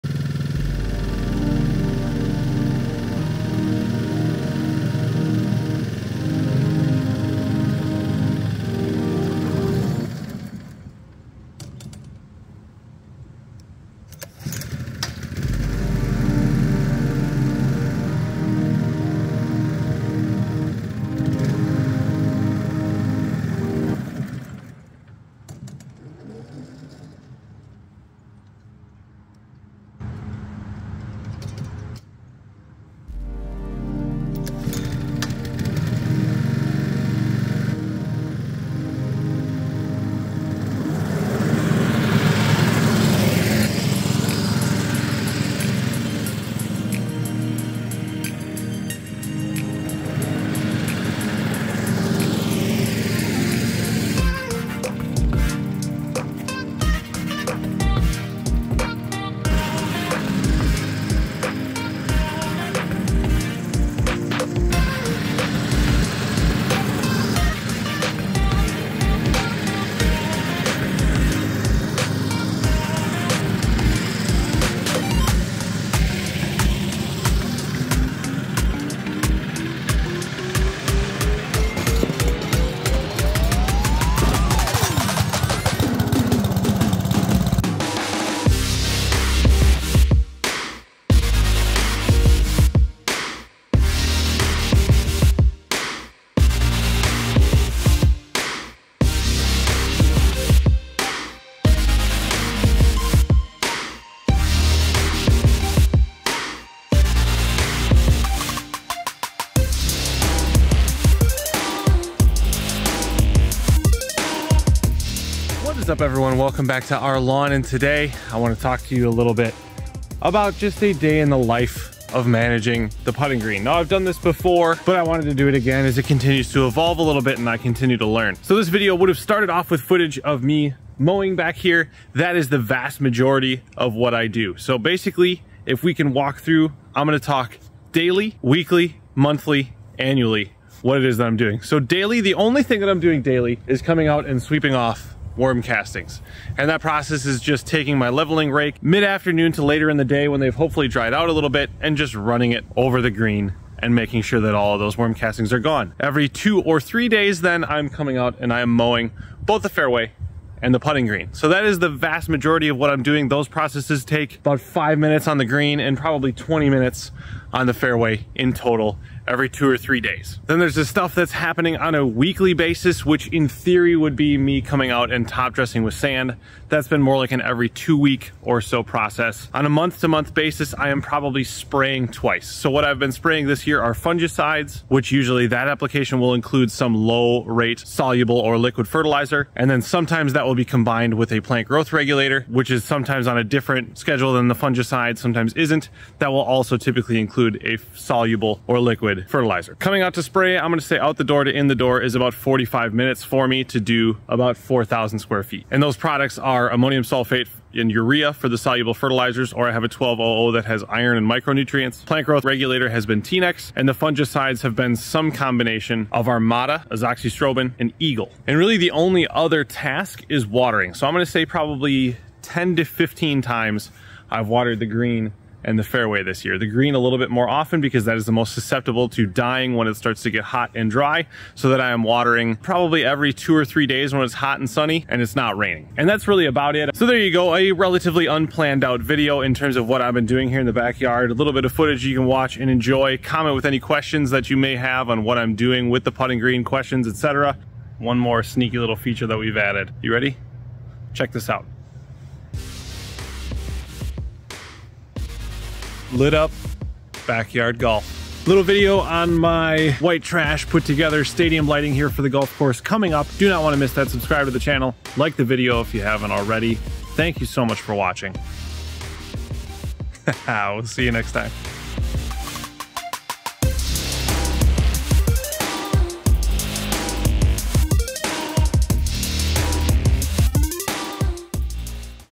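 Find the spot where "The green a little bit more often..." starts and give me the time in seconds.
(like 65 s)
226 s.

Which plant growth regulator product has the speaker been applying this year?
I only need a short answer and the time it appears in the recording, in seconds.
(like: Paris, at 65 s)
T-Nex, at 213 s.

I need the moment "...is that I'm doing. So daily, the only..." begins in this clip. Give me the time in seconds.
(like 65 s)
141 s.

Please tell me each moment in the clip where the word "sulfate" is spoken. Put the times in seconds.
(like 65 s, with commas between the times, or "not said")
207 s.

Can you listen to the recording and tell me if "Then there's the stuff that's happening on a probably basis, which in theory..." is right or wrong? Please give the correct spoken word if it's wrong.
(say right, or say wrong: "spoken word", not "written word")
wrong: "weekly", not "probably".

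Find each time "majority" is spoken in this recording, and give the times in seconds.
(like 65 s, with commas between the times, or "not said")
133 s, 162 s.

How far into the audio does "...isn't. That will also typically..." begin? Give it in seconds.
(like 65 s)
195 s.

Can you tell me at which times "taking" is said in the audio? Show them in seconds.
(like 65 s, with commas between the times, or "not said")
147 s.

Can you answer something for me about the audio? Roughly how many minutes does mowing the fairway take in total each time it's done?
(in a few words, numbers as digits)
20.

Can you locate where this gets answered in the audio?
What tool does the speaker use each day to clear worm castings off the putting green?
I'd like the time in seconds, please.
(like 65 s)
148 s.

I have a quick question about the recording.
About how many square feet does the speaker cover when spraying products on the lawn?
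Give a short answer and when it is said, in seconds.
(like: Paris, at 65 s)
4,000, at 204 s.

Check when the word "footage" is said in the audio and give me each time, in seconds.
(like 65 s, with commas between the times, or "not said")
129 s, 241 s.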